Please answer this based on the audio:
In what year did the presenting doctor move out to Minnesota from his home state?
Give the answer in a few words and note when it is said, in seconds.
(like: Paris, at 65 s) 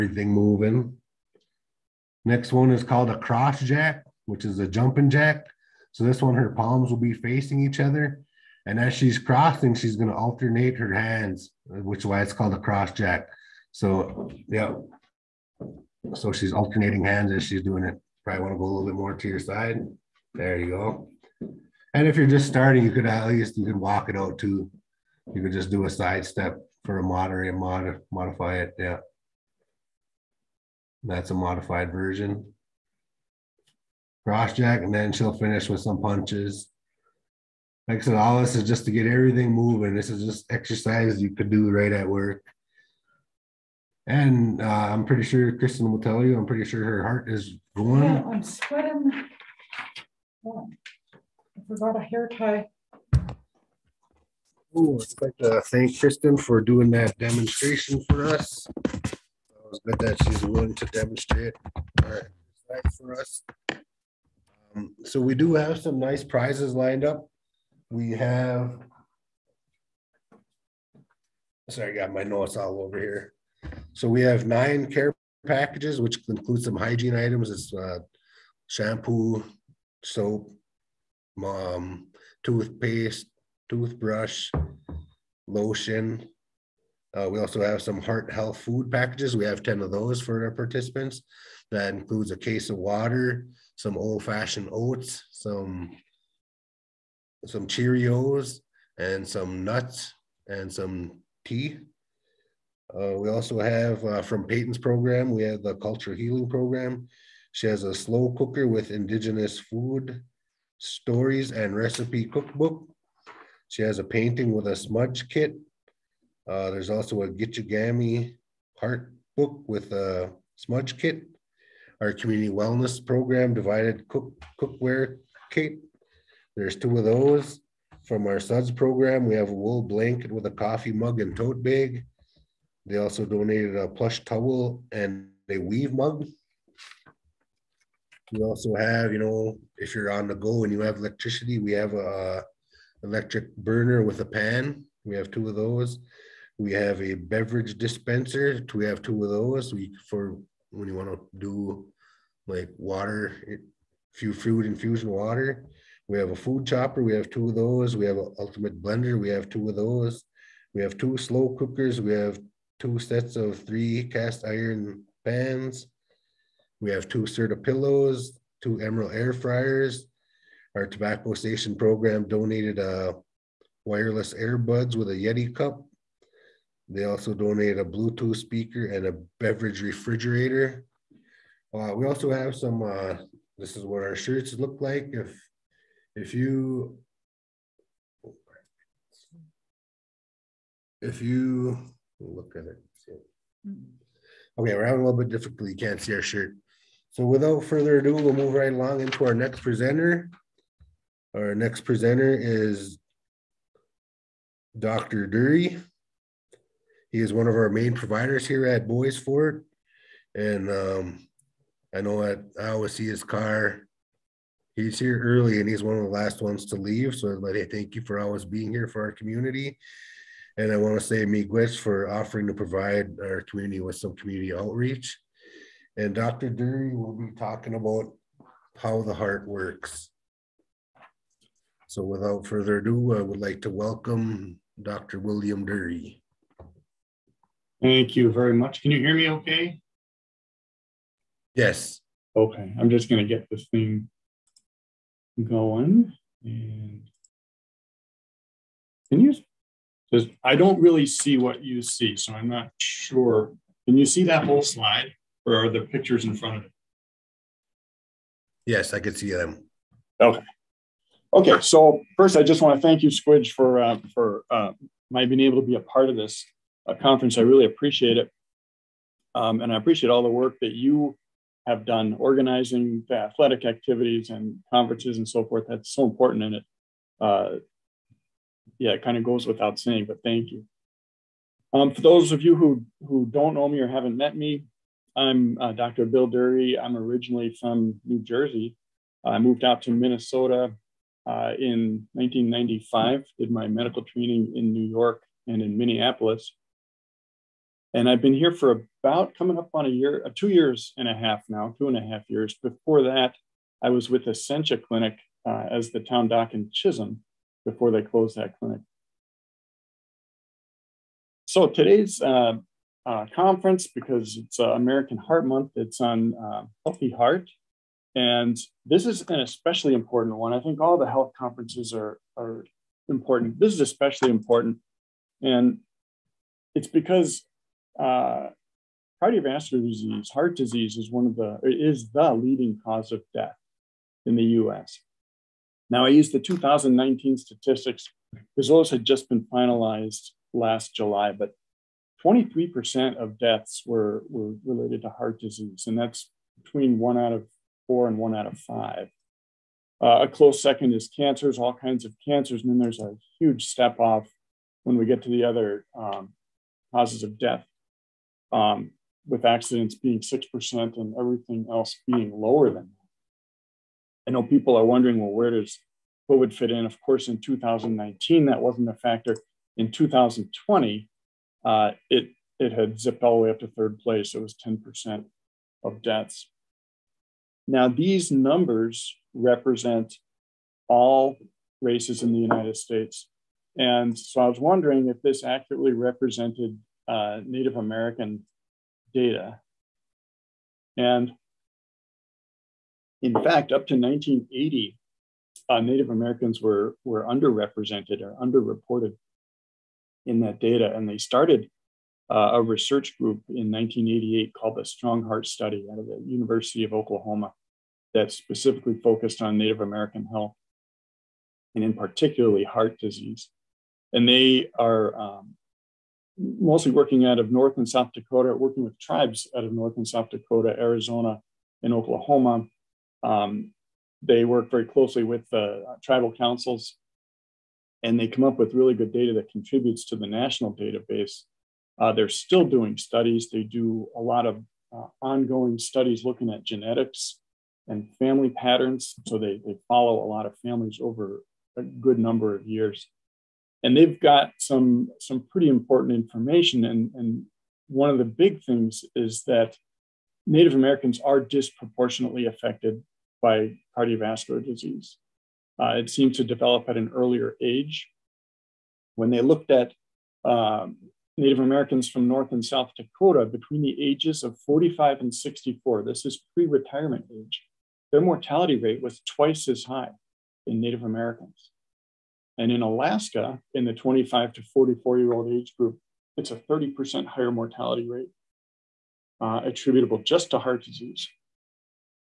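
1995, at 292 s.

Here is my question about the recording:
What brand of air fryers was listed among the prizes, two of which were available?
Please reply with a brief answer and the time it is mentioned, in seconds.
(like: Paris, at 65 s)
Emerald, at 168 s.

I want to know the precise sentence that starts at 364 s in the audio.
I know people are wondering, well, where does COVID fit in?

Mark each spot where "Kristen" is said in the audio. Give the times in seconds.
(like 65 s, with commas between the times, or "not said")
45 s, 55 s.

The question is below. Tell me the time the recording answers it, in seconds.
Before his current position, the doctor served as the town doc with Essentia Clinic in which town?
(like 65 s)
306 s.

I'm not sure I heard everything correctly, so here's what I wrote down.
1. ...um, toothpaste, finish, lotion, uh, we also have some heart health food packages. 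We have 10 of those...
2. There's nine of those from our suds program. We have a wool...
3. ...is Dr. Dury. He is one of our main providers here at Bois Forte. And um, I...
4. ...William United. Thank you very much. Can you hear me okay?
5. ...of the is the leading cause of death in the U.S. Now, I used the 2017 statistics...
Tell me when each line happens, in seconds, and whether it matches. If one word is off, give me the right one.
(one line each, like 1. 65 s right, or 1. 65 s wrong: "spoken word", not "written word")
1. 81 s wrong: "toothbrush", not "finish"
2. 126 s wrong: "two", not "nine"
3. 202 s right
4. 235 s wrong: "Dury", not "United"
5. 331 s wrong: "2019", not "2017".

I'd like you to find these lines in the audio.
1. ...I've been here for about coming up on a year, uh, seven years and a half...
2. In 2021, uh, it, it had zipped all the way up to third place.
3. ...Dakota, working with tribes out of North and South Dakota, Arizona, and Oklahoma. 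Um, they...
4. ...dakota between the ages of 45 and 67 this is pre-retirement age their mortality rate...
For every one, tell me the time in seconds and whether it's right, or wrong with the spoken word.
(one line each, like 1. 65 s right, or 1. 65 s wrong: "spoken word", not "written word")
1. 298 s wrong: "two", not "seven"
2. 369 s wrong: "2020", not "2021"
3. 418 s right
4. 462 s wrong: "64", not "67".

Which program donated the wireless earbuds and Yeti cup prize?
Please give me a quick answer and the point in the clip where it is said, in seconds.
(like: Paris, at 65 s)
tobacco station program, at 170 s.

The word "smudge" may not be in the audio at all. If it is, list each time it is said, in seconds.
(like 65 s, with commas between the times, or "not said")
114 s, 120 s.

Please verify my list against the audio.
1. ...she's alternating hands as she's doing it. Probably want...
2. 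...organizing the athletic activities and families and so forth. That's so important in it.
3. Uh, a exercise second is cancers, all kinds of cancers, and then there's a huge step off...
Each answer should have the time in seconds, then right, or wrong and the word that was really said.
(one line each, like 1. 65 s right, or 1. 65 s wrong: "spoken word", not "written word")
1. 16 s right
2. 272 s wrong: "conferences", not "families"
3. 350 s wrong: "close", not "exercise".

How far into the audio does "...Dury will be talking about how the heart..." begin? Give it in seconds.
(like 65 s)
226 s.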